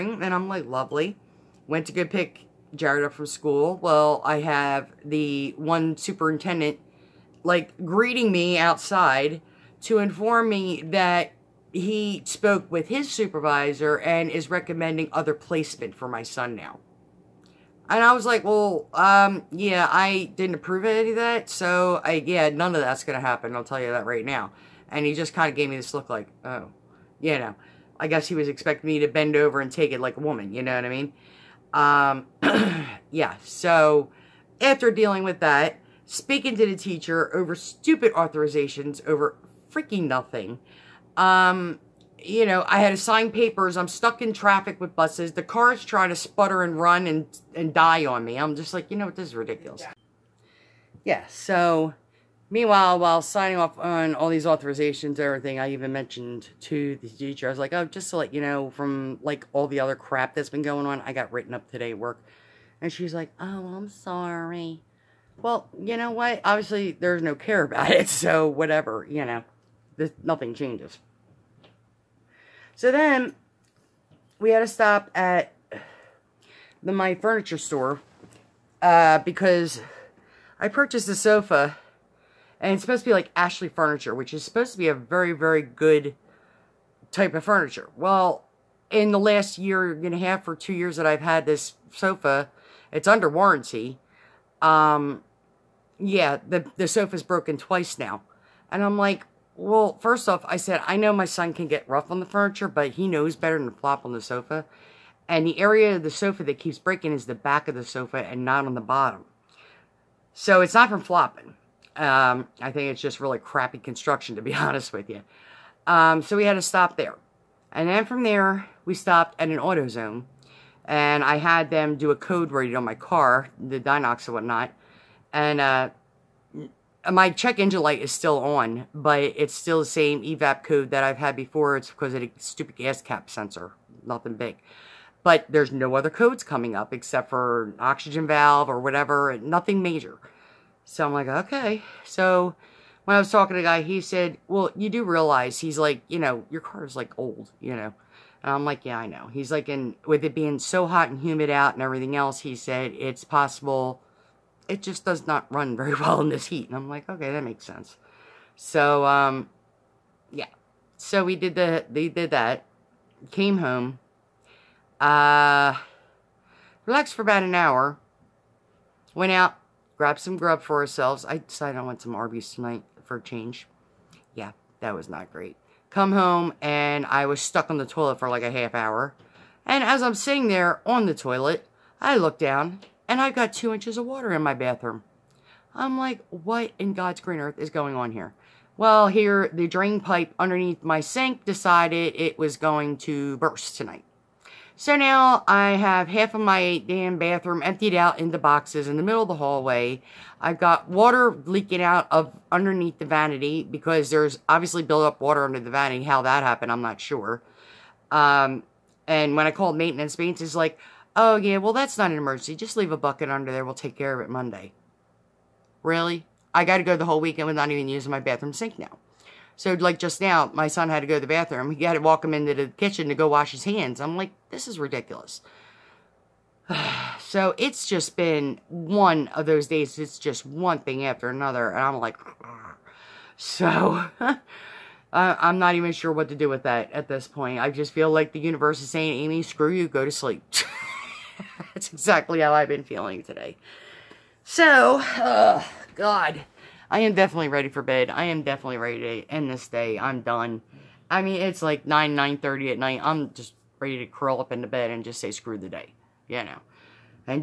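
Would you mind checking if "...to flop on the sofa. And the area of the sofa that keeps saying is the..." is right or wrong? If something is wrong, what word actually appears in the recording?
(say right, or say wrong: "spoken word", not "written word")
wrong: "breaking", not "saying".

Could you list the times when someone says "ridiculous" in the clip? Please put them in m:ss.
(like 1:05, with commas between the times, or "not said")
0:49, 3:44.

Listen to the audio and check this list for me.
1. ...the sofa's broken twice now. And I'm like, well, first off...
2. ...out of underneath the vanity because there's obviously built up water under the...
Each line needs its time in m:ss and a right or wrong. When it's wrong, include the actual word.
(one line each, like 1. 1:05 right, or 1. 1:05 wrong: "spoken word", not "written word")
1. 1:36 right
2. 3:21 right.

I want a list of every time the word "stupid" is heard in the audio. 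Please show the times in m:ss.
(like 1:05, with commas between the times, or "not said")
0:37, 2:12.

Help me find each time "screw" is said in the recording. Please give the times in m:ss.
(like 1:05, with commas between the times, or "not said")
3:59, 4:15.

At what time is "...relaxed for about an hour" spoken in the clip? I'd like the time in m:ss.
2:46.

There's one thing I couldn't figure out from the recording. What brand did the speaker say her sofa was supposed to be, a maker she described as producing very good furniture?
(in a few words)
Ashley Furniture.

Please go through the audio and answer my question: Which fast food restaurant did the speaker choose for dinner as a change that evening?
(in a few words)
Arby's.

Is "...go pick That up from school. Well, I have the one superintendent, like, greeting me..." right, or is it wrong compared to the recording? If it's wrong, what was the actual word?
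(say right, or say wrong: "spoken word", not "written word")
wrong: "Jared", not "That".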